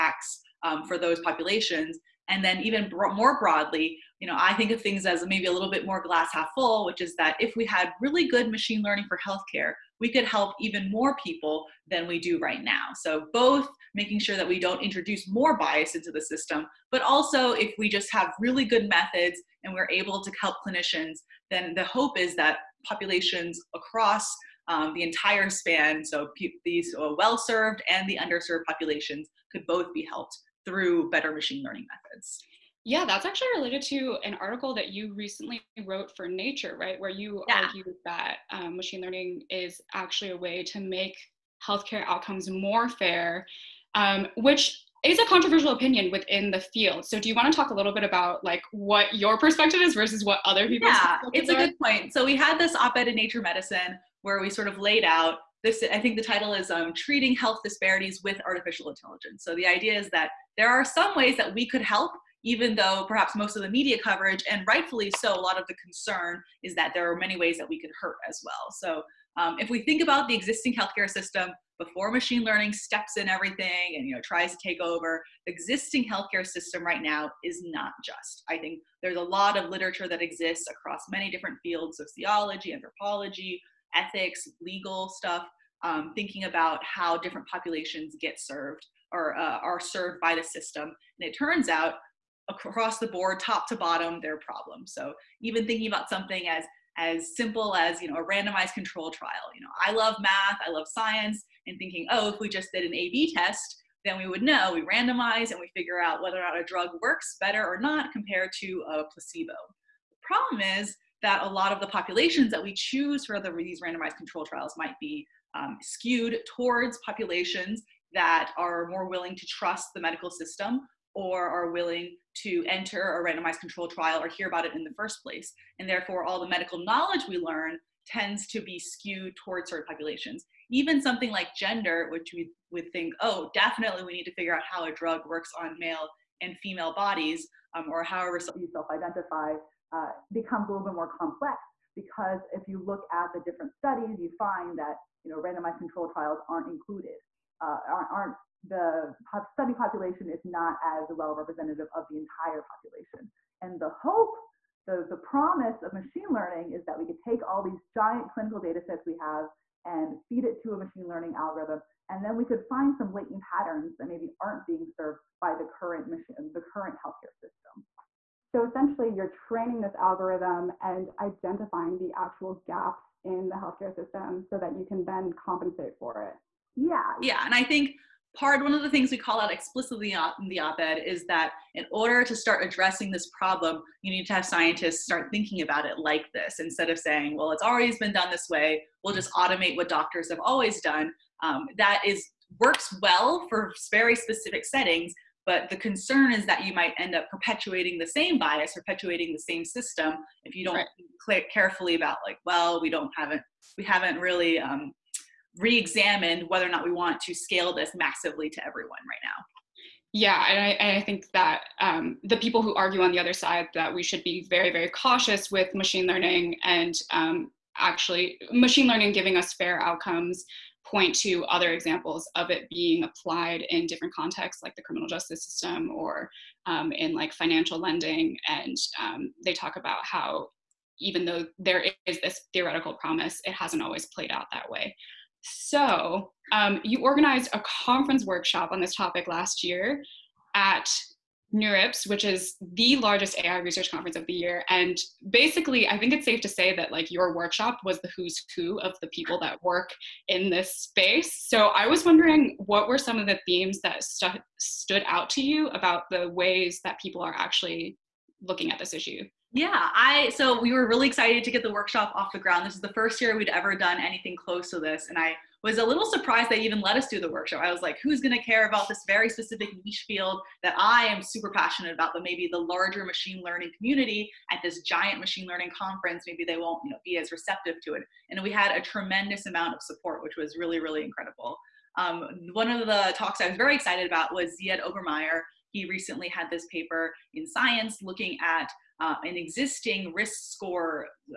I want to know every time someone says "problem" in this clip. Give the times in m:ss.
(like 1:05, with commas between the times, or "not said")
1:34, 1:50, 3:03.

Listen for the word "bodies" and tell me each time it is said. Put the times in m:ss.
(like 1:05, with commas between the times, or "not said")
2:16.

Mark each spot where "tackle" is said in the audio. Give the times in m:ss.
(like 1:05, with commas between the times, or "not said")
not said.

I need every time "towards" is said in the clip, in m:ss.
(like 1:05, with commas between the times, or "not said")
1:56, 2:09.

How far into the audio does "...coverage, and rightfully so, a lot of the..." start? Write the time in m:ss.
1:04.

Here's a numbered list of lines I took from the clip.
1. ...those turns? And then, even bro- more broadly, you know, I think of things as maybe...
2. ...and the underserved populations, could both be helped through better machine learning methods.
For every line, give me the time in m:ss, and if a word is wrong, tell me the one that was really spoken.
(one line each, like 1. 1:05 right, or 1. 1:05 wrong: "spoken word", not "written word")
1. 0:00 wrong: "populations", not "turns"
2. 0:27 right.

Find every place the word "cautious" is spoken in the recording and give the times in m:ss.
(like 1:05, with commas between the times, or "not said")
3:34.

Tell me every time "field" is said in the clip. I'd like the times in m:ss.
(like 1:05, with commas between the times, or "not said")
0:46, 1:21, 4:30.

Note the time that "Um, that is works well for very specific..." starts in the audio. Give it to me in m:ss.
3:11.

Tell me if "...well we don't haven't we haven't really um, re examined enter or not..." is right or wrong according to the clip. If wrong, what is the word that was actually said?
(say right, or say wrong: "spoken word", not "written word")
wrong: "whether", not "enter".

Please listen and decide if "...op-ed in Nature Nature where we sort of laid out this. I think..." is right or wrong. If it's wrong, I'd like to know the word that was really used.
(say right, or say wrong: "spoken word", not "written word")
wrong: "Medicine", not "Nature".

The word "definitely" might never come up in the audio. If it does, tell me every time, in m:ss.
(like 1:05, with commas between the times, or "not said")
2:13.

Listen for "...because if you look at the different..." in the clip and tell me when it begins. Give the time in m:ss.
2:21.